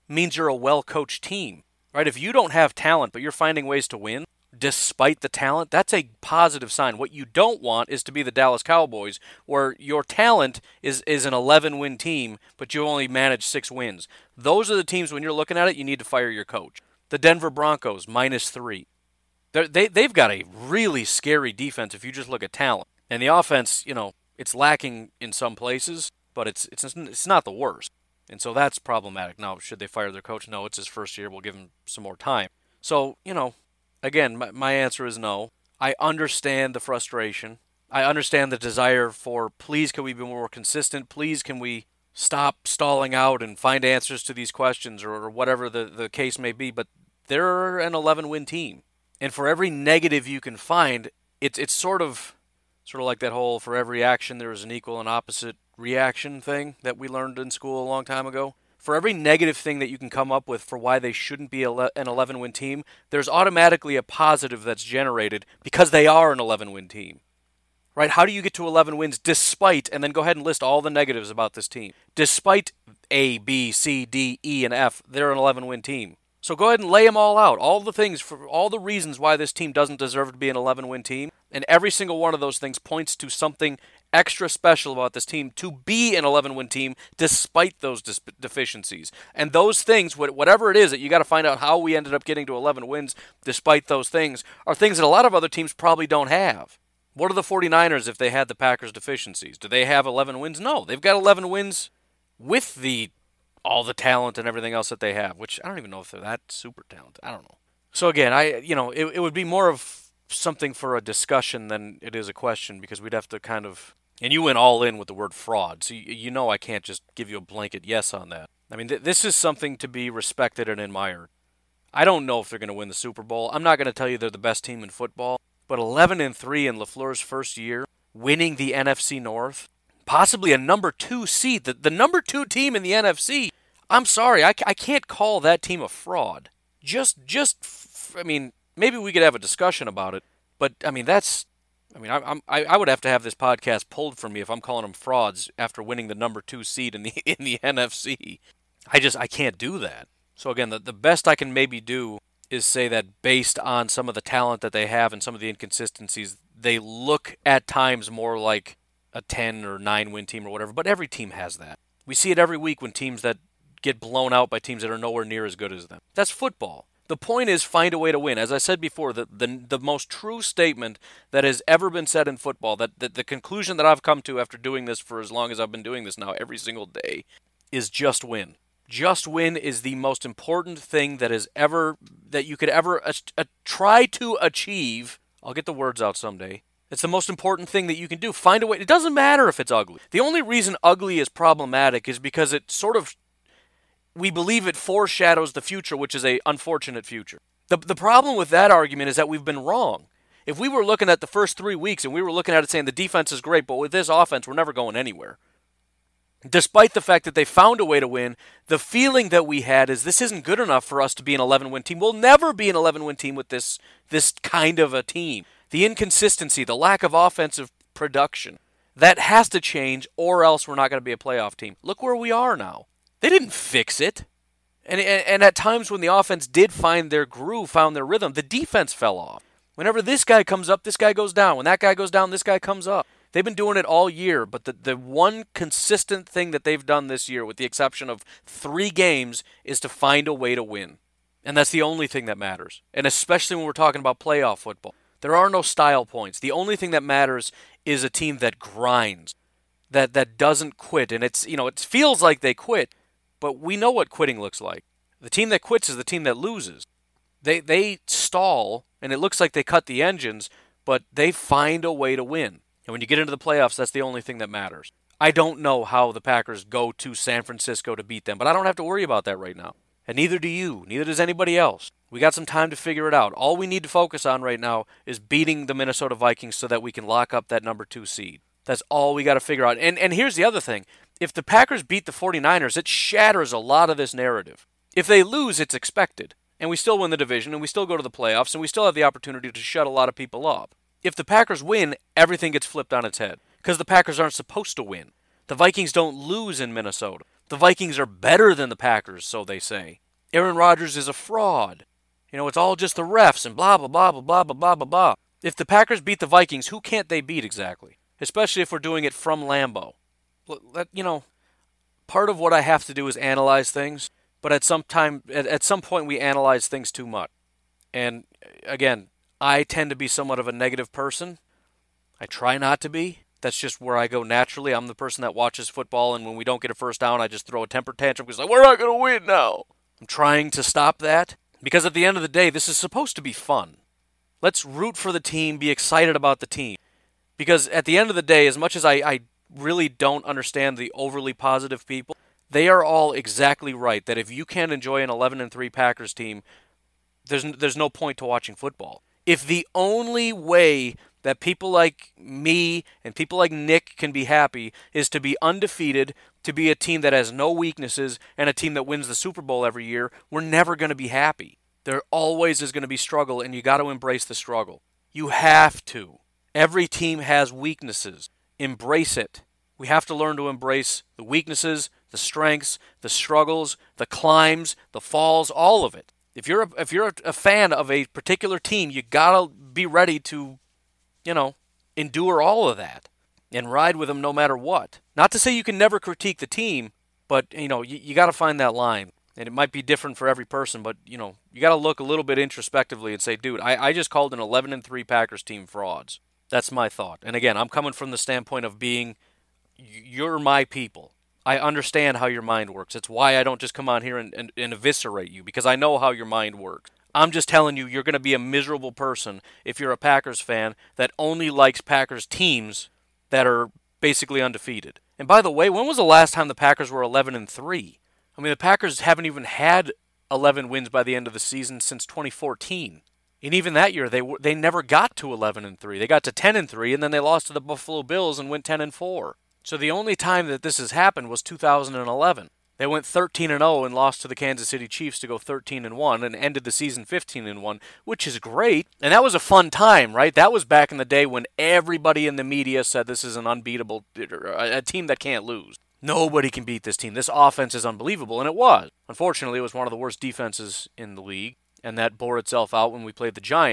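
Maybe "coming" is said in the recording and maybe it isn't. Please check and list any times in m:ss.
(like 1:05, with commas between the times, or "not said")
6:37.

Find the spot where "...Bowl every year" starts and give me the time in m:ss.
5:59.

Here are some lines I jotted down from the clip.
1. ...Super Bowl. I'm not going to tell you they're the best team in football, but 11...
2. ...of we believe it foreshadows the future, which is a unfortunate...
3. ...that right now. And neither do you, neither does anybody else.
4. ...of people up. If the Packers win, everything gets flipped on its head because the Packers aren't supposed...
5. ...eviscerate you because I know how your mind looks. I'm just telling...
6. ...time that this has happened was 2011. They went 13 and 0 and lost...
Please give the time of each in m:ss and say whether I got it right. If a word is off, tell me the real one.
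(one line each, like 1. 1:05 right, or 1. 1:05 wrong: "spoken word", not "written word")
1. 2:02 right
2. 3:12 right
3. 4:29 right
4. 4:50 right
5. 6:44 wrong: "works", not "looks"
6. 7:10 right.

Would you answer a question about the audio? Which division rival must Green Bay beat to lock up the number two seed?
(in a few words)
Minnesota Vikings.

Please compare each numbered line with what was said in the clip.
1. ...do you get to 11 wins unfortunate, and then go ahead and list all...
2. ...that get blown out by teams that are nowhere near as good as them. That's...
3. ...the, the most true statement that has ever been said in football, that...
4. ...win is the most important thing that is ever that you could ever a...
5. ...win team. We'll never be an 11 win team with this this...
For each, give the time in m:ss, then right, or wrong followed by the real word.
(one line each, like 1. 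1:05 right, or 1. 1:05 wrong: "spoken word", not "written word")
1. 1:08 wrong: "despite", not "unfortunate"
2. 2:43 right
3. 2:49 right
4. 2:59 right
5. 3:31 right.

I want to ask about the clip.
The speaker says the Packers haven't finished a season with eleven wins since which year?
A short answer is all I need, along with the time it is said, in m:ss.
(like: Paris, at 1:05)
2014, at 7:02.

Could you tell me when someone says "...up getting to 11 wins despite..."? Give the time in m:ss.
1:32.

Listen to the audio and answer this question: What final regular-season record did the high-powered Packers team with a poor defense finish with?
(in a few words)
15 and 1.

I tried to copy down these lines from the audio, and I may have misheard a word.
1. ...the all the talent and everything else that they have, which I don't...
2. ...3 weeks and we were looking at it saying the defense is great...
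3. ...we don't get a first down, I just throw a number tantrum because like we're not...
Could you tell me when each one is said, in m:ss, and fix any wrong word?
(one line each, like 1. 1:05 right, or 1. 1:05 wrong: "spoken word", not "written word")
1. 1:42 right
2. 3:21 right
3. 5:26 wrong: "temper", not "number".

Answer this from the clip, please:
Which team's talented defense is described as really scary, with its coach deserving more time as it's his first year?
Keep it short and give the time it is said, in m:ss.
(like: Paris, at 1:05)
Denver Broncos, at 0:17.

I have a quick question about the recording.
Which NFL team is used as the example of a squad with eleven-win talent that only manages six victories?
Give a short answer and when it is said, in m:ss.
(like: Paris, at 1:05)
Dallas Cowboys, at 0:08.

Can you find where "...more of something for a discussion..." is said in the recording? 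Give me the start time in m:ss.
1:49.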